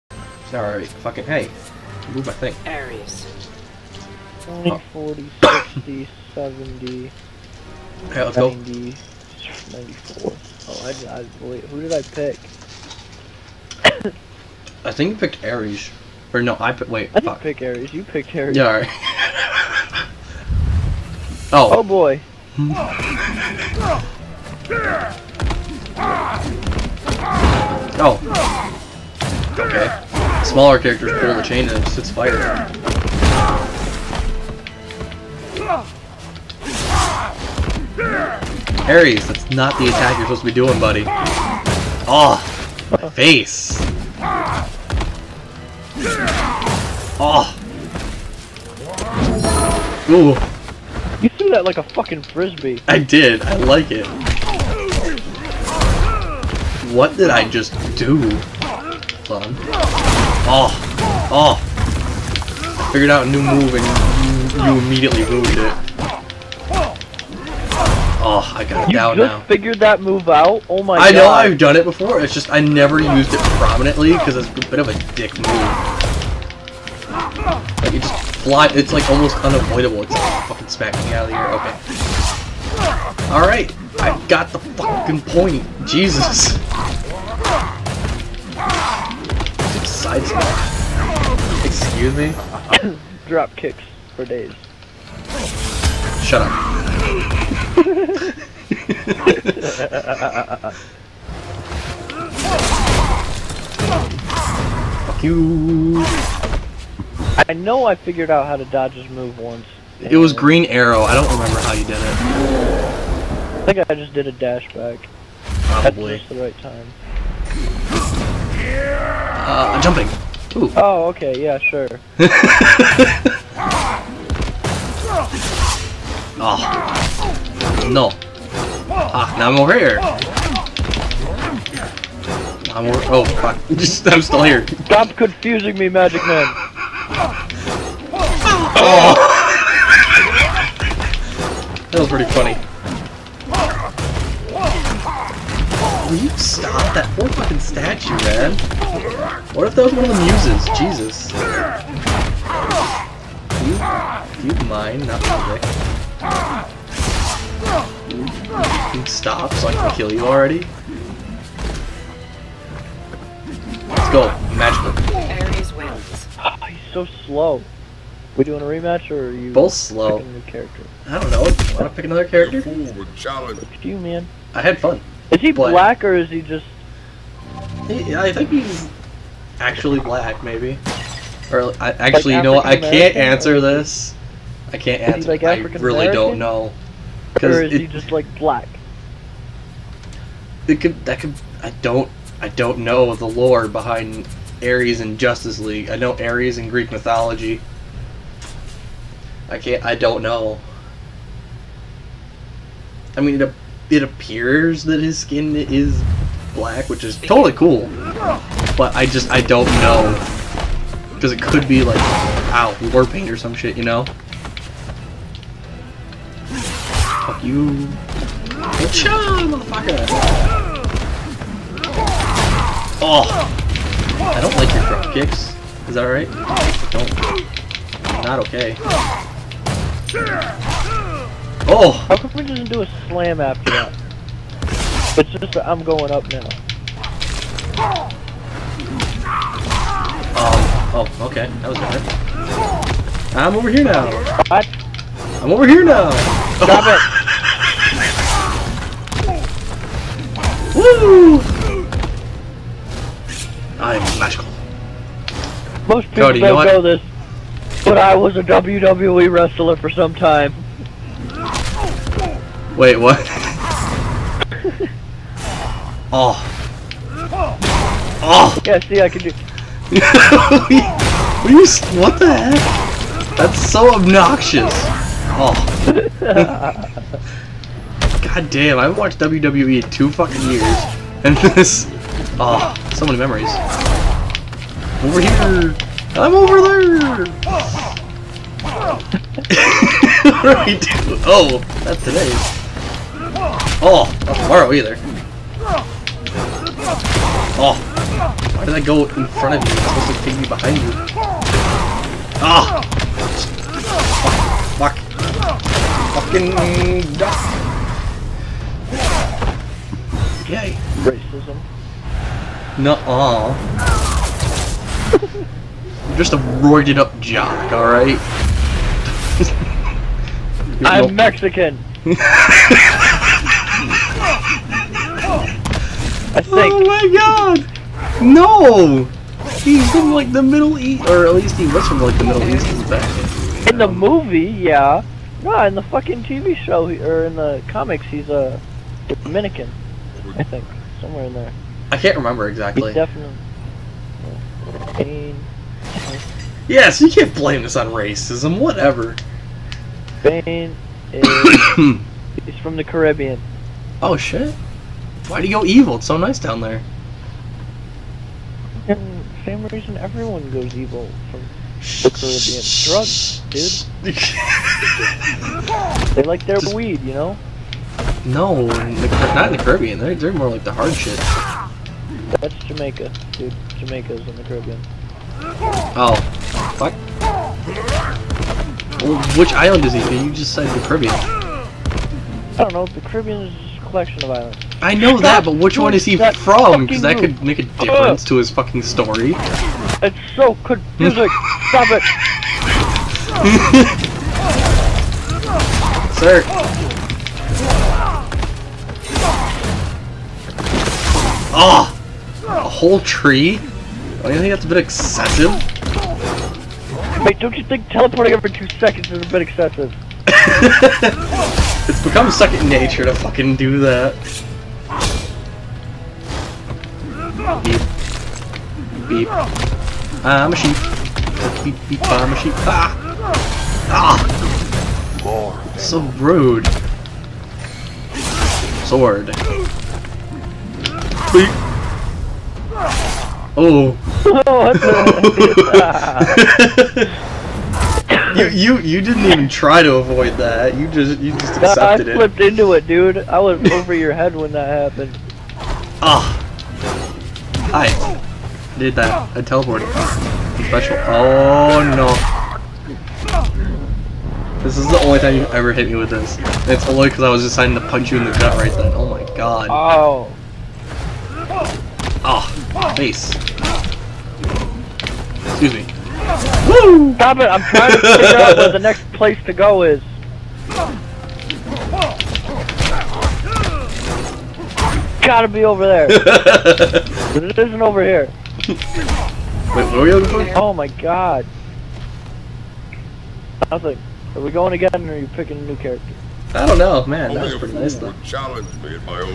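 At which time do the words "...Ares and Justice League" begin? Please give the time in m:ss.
3:14.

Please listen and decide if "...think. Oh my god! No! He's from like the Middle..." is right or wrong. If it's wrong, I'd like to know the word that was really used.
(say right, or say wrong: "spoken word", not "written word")
right.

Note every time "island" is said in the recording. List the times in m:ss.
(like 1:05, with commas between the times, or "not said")
6:19, 6:24.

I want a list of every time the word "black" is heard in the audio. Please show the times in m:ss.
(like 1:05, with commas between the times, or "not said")
2:55, 2:59, 3:08, 3:26.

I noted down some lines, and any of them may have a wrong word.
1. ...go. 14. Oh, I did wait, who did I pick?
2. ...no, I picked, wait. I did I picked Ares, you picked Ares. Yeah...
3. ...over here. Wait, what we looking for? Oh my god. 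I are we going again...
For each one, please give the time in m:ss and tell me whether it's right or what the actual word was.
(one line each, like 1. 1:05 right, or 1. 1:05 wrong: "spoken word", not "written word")
1. 0:08 wrong: "94", not "14"
2. 0:16 right
3. 7:57 right.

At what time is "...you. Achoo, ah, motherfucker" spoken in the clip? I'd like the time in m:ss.
3:37.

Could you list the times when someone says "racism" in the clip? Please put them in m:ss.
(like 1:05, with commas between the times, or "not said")
5:11, 5:47.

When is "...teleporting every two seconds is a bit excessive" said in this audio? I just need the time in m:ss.
6:47.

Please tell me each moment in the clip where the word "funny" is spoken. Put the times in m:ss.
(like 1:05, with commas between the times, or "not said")
2:22.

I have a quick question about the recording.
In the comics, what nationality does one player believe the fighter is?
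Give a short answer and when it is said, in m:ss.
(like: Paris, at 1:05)
Dominican, at 5:39.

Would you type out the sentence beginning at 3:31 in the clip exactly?
Because it could be like, ow, war paint or some shit, you know?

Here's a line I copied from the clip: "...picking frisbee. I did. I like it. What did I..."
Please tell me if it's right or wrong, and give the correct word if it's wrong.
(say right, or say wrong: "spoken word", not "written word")
wrong: "fucking", not "picking".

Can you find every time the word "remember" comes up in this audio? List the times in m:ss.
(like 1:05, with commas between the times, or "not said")
1:51, 5:42.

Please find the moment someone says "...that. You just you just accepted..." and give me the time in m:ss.
7:20.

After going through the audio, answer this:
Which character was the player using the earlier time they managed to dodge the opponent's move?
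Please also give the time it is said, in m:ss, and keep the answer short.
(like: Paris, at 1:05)
Green Arrow, at 1:50.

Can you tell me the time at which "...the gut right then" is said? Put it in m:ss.
7:38.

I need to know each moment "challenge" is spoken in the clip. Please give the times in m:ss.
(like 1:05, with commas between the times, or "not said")
2:53, 8:08.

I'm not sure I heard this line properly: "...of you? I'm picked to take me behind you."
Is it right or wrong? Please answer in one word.
wrong.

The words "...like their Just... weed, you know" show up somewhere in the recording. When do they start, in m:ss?
6:06.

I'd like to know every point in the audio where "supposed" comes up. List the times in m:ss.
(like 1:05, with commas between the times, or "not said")
0:40, 4:59.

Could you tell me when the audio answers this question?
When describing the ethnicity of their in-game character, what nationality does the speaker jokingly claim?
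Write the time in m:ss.
5:20.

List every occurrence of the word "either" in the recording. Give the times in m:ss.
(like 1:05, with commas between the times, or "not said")
4:54.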